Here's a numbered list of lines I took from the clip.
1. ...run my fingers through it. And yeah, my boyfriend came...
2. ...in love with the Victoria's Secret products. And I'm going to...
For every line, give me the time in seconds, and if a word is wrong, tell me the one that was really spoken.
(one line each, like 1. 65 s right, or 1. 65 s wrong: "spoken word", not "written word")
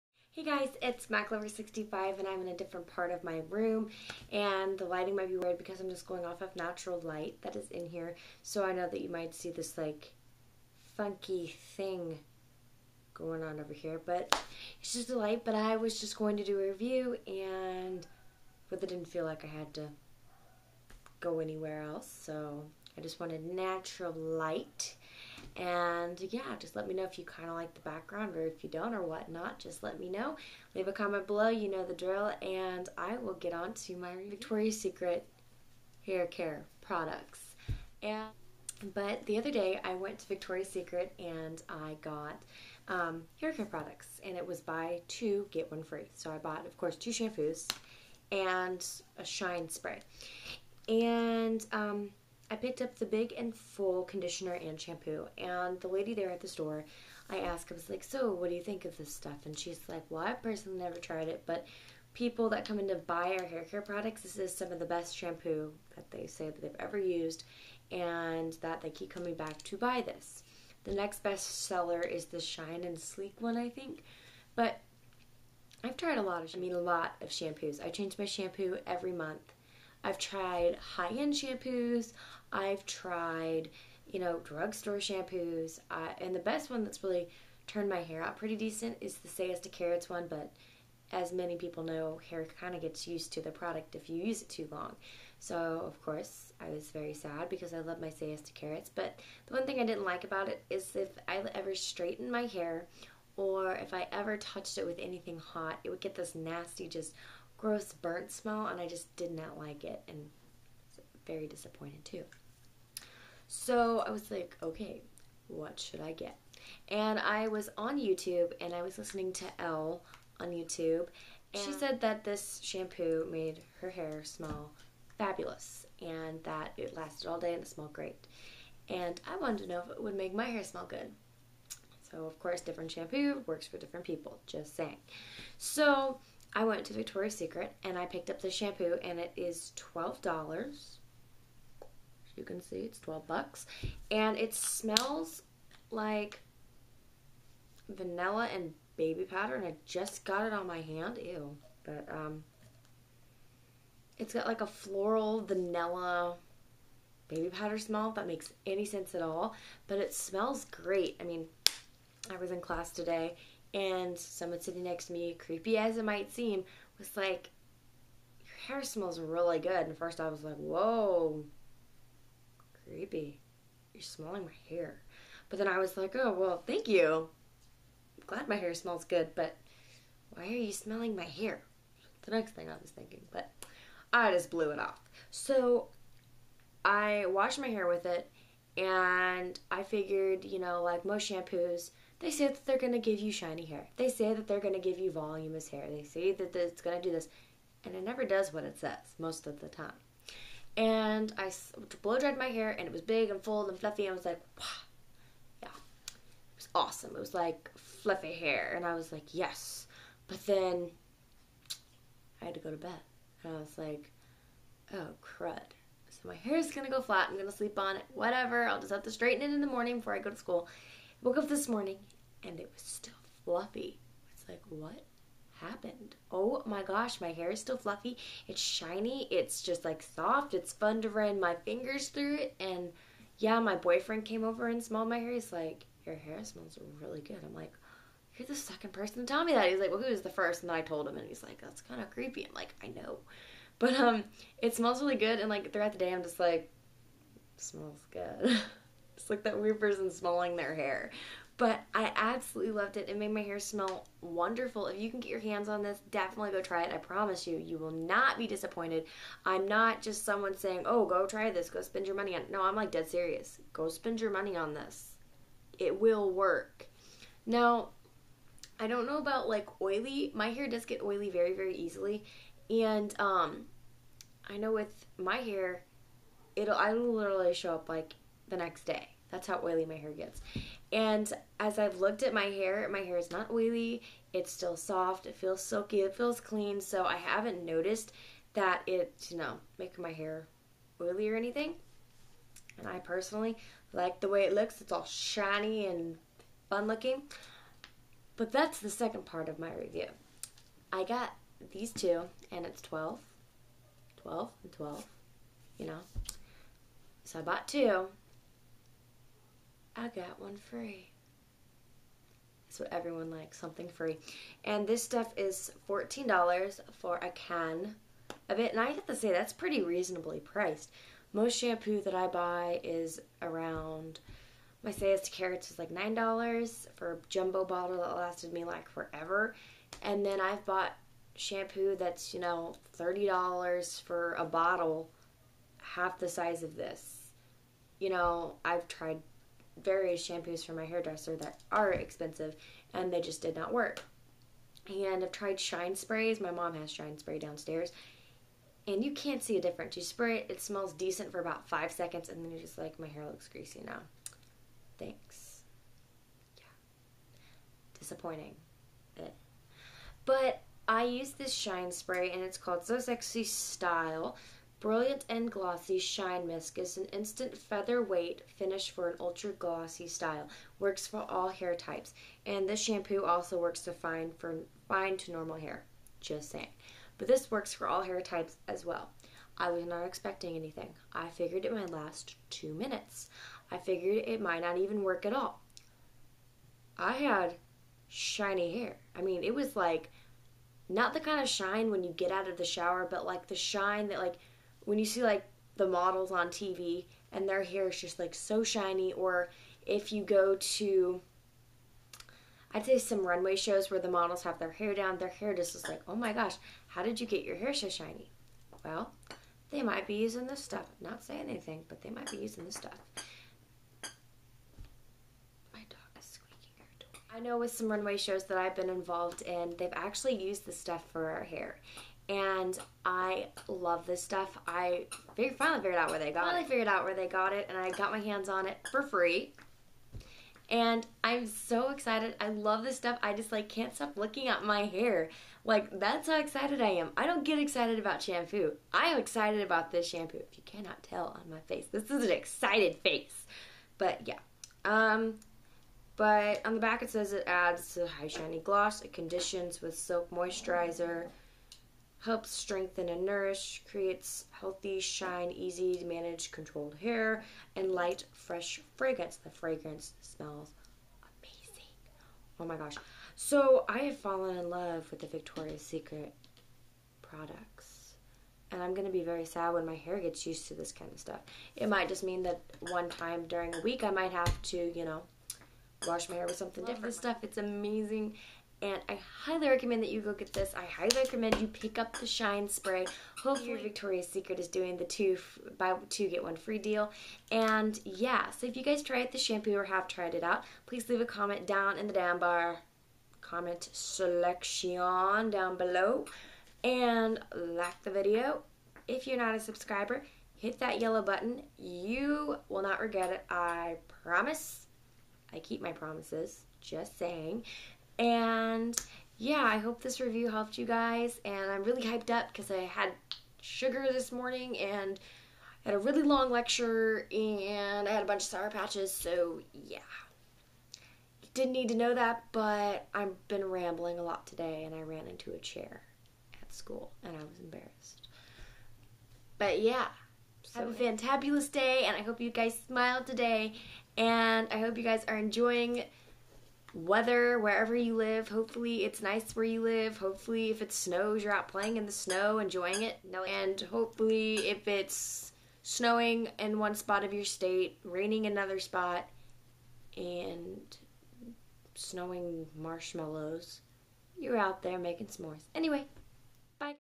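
1. 231 s right
2. 464 s right.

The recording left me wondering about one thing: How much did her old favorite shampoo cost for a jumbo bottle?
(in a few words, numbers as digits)
$9.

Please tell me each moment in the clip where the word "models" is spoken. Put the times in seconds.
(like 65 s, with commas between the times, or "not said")
395 s, 404 s.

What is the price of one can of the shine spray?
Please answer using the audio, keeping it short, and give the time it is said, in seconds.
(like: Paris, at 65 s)
$14, at 315 s.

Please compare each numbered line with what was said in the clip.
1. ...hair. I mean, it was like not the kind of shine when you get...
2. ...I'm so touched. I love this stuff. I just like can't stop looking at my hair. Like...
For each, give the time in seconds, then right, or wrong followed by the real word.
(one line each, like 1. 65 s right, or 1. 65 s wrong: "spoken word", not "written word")
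1. 388 s right
2. 431 s wrong: "excited", not "touched".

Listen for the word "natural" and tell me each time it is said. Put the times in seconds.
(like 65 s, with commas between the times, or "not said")
6 s, 23 s.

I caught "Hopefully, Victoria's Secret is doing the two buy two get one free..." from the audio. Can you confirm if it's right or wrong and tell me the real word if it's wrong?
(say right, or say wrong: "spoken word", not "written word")
right.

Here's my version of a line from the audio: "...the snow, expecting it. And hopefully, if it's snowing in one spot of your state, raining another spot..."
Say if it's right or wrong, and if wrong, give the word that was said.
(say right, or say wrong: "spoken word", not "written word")
wrong: "enjoying", not "expecting".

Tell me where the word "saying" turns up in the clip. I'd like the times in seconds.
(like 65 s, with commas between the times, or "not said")
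134 s, 260 s, 376 s, 411 s, 507 s.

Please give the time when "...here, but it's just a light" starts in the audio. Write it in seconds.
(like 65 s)
13 s.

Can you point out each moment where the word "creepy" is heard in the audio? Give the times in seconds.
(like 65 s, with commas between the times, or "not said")
165 s, 172 s, 242 s.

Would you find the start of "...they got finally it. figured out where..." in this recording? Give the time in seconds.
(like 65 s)
426 s.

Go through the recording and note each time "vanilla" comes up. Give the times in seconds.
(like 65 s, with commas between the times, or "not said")
147 s, 155 s.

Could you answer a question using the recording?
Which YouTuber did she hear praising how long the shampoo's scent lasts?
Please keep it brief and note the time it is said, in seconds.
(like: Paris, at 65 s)
Elle, at 119 s.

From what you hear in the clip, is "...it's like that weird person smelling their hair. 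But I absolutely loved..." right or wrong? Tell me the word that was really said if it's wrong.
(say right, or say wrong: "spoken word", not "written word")
right.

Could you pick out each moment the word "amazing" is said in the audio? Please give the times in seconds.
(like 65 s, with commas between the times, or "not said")
461 s, 477 s.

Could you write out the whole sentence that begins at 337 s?
You know, I've tried various shampoos from my hairdresser that are expensive and they just did not work.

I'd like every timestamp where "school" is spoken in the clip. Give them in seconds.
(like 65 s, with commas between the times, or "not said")
220 s, 526 s.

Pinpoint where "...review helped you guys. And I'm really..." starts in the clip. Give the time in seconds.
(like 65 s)
510 s.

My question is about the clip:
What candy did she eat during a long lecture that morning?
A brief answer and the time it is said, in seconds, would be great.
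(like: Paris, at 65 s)
Sour Patches, at 518 s.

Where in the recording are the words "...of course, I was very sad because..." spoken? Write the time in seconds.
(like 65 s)
95 s.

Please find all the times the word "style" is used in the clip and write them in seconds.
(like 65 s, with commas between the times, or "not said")
363 s, 370 s.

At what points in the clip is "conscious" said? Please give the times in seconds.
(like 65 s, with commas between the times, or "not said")
not said.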